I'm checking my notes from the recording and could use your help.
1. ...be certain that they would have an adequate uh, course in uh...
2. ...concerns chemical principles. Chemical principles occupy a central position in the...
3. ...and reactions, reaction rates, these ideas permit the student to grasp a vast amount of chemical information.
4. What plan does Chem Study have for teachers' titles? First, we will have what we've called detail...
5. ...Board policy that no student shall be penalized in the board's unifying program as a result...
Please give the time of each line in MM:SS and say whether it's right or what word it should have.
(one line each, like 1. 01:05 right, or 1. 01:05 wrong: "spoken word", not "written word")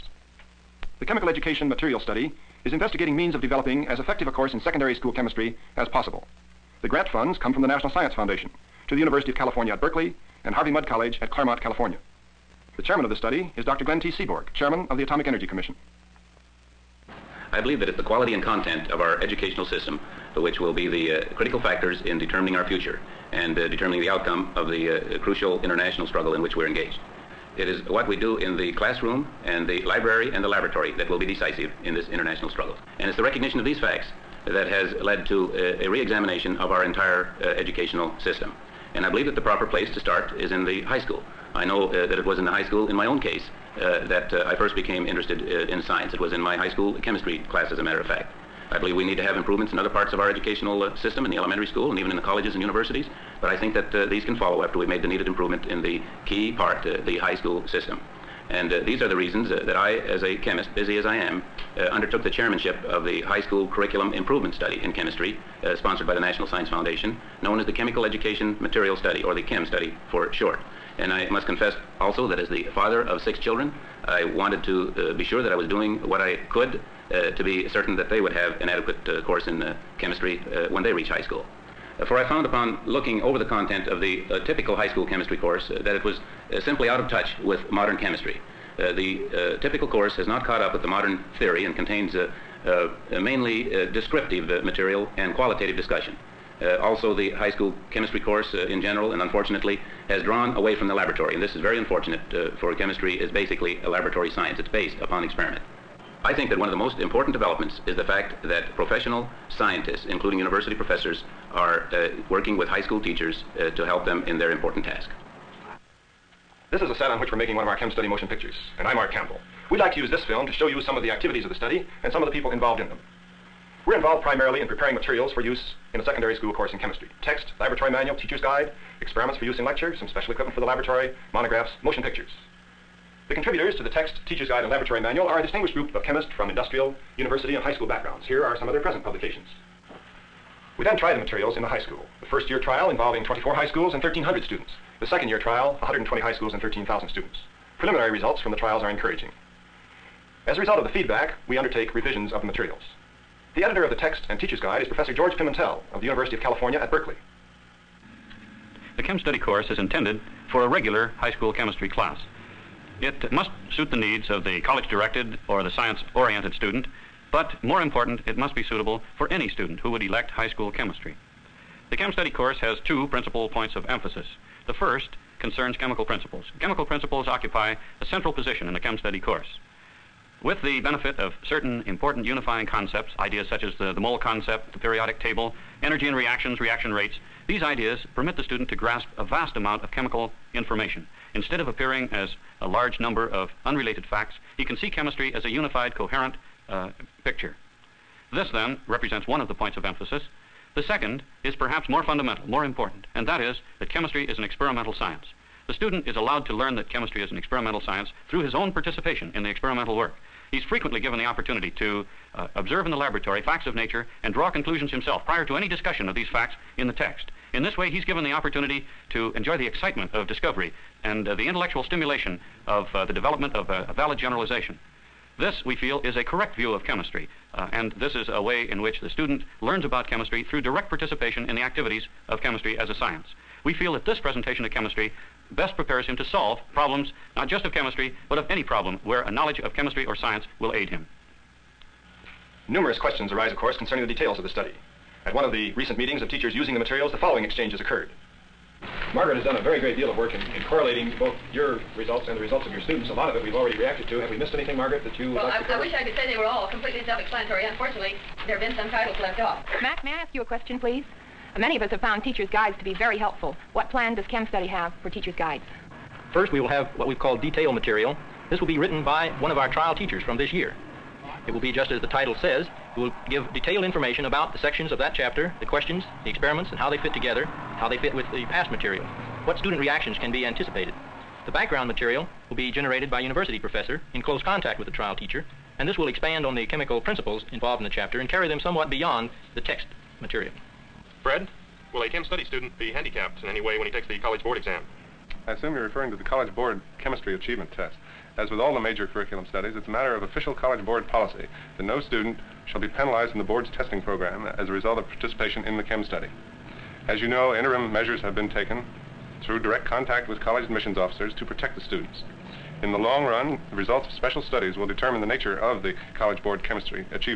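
1. 01:17 right
2. 02:55 right
3. 03:06 right
4. 04:23 wrong: "guides", not "titles"
5. 05:00 wrong: "testing", not "unifying".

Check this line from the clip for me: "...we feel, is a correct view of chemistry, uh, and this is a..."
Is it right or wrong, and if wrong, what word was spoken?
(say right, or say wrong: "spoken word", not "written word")
right.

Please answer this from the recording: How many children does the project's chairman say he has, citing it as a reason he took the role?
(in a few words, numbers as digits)
6.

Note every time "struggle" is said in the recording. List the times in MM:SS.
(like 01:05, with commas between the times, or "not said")
00:26, 00:32.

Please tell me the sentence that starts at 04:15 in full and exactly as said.
I wish I could say they were all completely self-explanatory.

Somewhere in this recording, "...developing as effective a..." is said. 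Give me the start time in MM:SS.
00:03.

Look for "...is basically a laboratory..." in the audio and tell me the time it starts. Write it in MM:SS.
01:43.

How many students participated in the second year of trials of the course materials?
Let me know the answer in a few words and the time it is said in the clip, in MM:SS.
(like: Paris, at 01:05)
13,000, at 02:26.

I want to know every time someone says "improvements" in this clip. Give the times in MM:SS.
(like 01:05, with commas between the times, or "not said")
00:49, 00:55, 01:04.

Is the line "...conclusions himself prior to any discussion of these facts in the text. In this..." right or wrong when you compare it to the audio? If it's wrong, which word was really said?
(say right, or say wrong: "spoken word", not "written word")
right.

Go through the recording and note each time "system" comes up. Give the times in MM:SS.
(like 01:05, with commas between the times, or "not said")
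00:19, 00:38, 00:50, 00:57.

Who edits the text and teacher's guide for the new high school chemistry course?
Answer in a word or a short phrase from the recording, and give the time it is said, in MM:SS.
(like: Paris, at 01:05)
George Pimentel, at 02:35.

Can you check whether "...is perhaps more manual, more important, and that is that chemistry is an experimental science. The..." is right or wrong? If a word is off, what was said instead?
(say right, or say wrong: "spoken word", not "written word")
wrong: "fundamental", not "manual".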